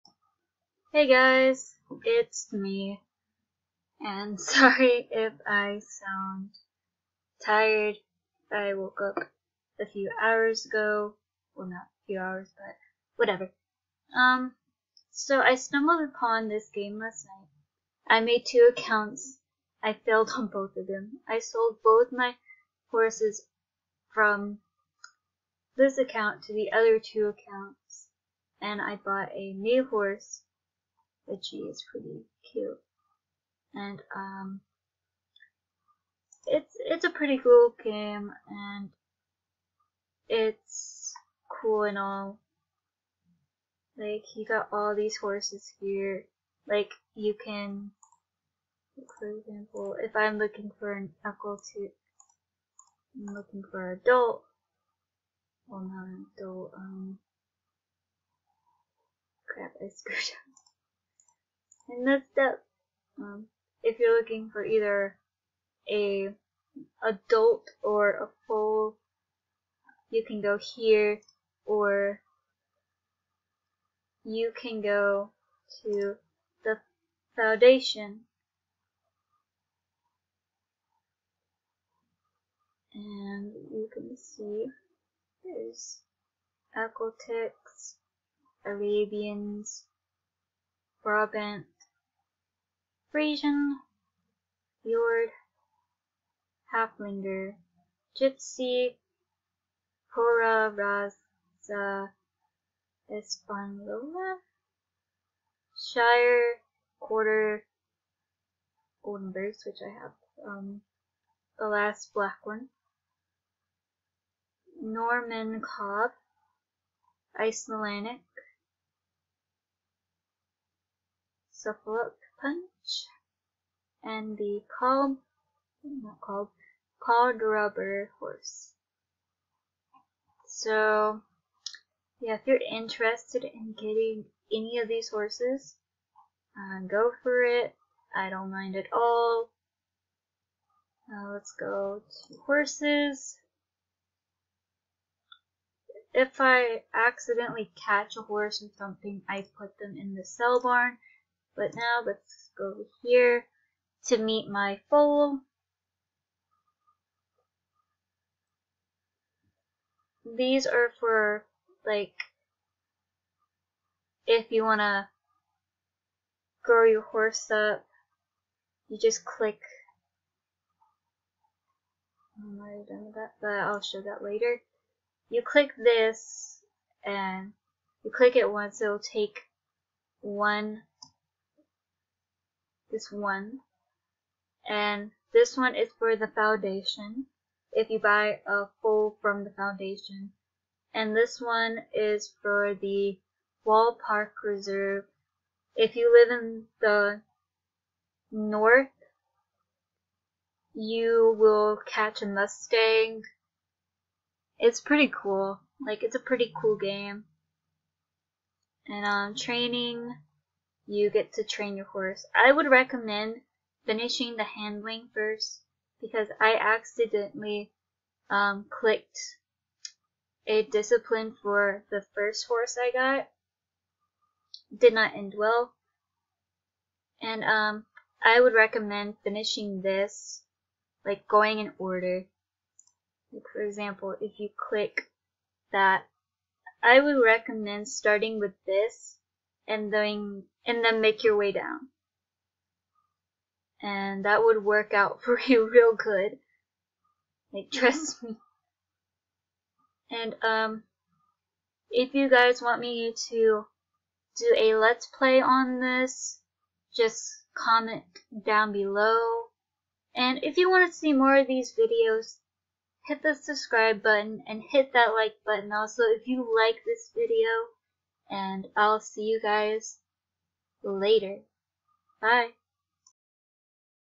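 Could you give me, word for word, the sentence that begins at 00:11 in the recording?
Well, not a few hours, but whatever.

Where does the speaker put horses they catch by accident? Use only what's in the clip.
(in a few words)
the sell barn.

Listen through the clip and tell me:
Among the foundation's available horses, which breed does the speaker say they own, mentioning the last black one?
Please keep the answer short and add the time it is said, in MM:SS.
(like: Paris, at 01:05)
Goldenbergs, at 01:49.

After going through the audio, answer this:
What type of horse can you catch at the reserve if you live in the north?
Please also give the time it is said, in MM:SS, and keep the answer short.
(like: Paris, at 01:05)
Mustang, at 03:22.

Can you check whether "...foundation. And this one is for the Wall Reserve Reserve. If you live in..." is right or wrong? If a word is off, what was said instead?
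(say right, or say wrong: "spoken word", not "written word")
wrong: "Park", not "Reserve".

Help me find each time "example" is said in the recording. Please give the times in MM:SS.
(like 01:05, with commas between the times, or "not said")
00:49, 03:53.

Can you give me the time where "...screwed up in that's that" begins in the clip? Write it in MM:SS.
00:59.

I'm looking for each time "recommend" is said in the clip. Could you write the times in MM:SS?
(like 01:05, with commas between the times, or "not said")
03:32, 03:48, 03:57.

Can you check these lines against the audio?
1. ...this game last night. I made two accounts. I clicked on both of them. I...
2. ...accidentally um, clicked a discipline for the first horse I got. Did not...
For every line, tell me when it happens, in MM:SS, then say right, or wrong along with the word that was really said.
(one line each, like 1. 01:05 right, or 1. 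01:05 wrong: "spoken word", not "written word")
1. 00:16 wrong: "failed", not "clicked"
2. 03:36 right.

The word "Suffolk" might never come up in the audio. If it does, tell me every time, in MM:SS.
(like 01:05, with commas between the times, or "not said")
02:01.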